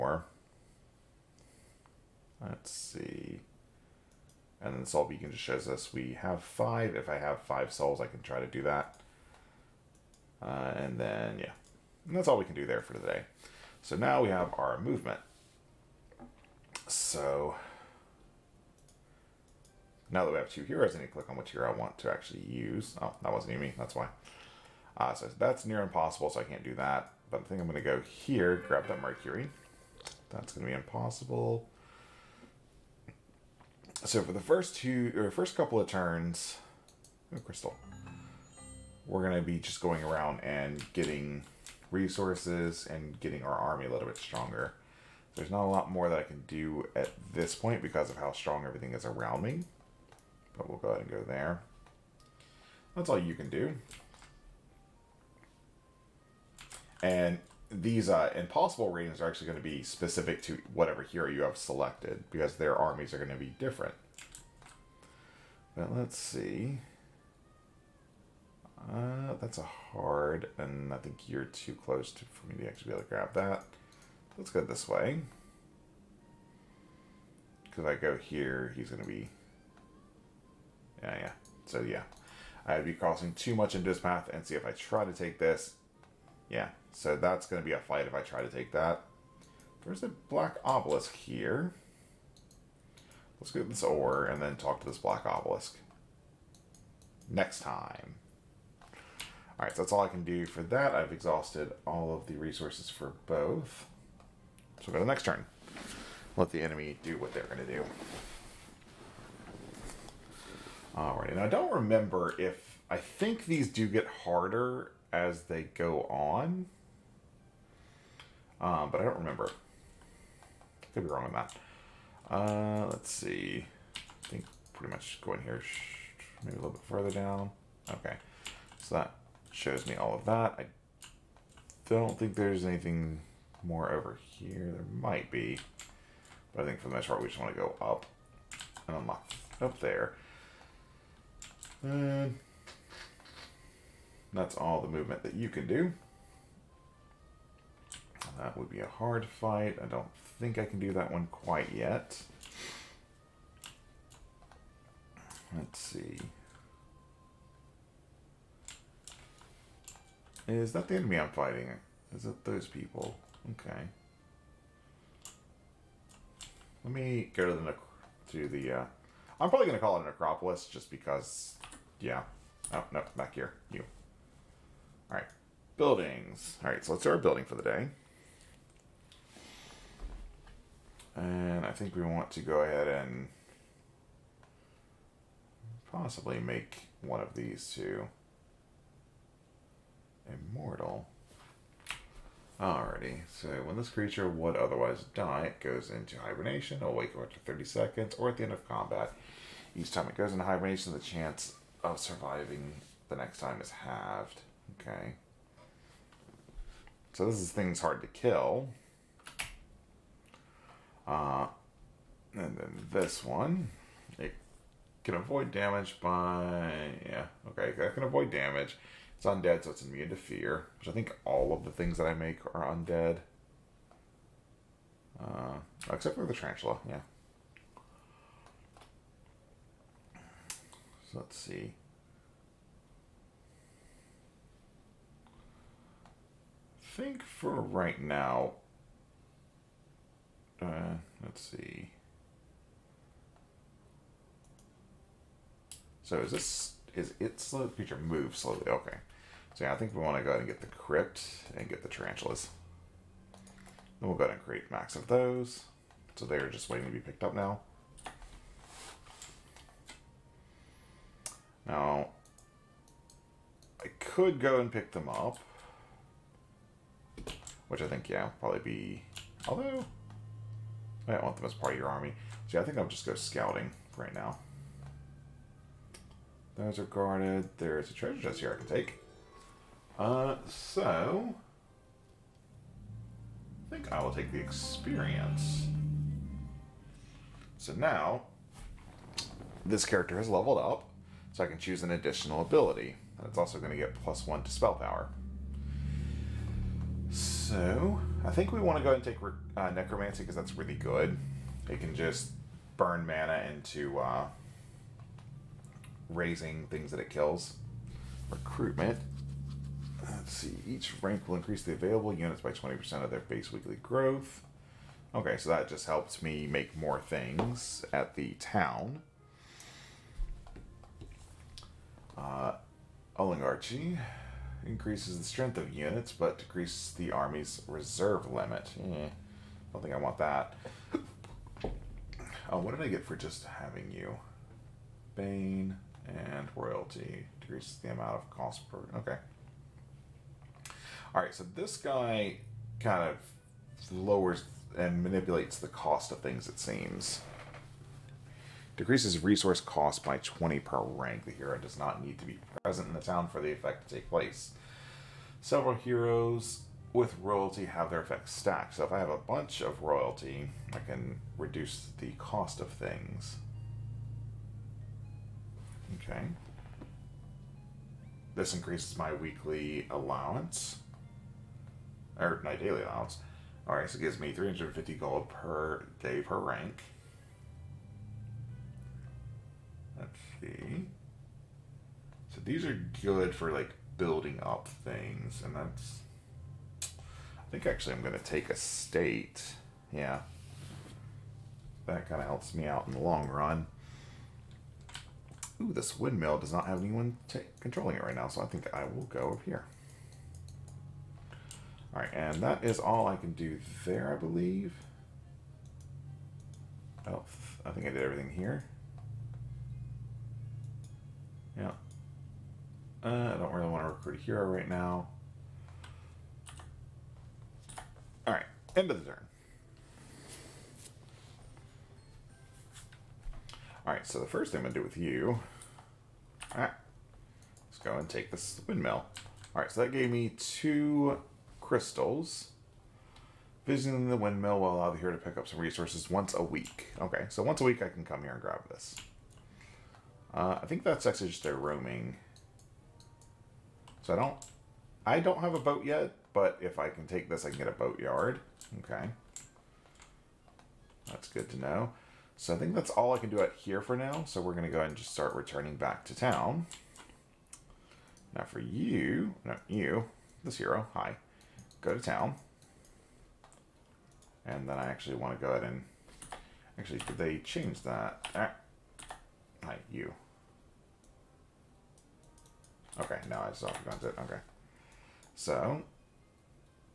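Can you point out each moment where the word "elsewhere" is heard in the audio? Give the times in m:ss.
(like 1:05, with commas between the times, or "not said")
not said.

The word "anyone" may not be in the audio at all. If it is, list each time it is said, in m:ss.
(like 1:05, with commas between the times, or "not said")
6:36.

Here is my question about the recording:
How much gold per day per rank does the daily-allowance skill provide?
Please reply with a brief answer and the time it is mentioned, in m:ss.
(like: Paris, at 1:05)
350, at 6:14.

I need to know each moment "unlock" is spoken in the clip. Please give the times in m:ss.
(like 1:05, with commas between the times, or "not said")
2:18.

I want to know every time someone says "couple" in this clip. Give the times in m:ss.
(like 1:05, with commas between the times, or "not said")
0:35.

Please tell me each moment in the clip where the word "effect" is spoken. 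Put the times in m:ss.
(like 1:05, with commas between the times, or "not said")
5:53, 5:58.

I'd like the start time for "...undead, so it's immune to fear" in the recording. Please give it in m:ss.
3:39.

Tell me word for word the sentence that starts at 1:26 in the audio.
Yeah, so that's going to be a fight if I try to take that.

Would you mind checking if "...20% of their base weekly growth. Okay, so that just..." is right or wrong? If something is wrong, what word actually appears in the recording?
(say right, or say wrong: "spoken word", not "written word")
right.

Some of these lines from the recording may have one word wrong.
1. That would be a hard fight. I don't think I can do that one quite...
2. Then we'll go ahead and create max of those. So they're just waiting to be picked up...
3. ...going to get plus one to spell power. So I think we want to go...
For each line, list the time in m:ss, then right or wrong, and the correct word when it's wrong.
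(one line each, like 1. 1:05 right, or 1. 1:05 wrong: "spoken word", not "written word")
1. 2:28 right
2. 4:13 right
3. 4:53 right.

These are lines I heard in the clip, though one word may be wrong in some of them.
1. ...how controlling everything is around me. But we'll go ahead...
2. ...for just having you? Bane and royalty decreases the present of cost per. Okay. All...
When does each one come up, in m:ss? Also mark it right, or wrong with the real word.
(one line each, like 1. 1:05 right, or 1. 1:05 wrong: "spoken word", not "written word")
1. 0:48 wrong: "strong", not "controlling"
2. 5:33 wrong: "amount", not "present".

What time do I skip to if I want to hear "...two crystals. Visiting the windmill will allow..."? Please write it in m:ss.
7:10.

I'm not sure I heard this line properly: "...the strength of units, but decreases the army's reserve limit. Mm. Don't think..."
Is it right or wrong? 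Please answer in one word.
right.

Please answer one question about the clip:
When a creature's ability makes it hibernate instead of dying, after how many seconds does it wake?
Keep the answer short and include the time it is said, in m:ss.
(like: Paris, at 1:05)
30, at 3:17.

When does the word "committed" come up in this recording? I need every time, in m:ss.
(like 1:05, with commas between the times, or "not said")
not said.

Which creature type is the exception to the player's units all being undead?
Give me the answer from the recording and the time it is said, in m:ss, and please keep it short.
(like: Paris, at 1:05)
Tarantula, at 3:46.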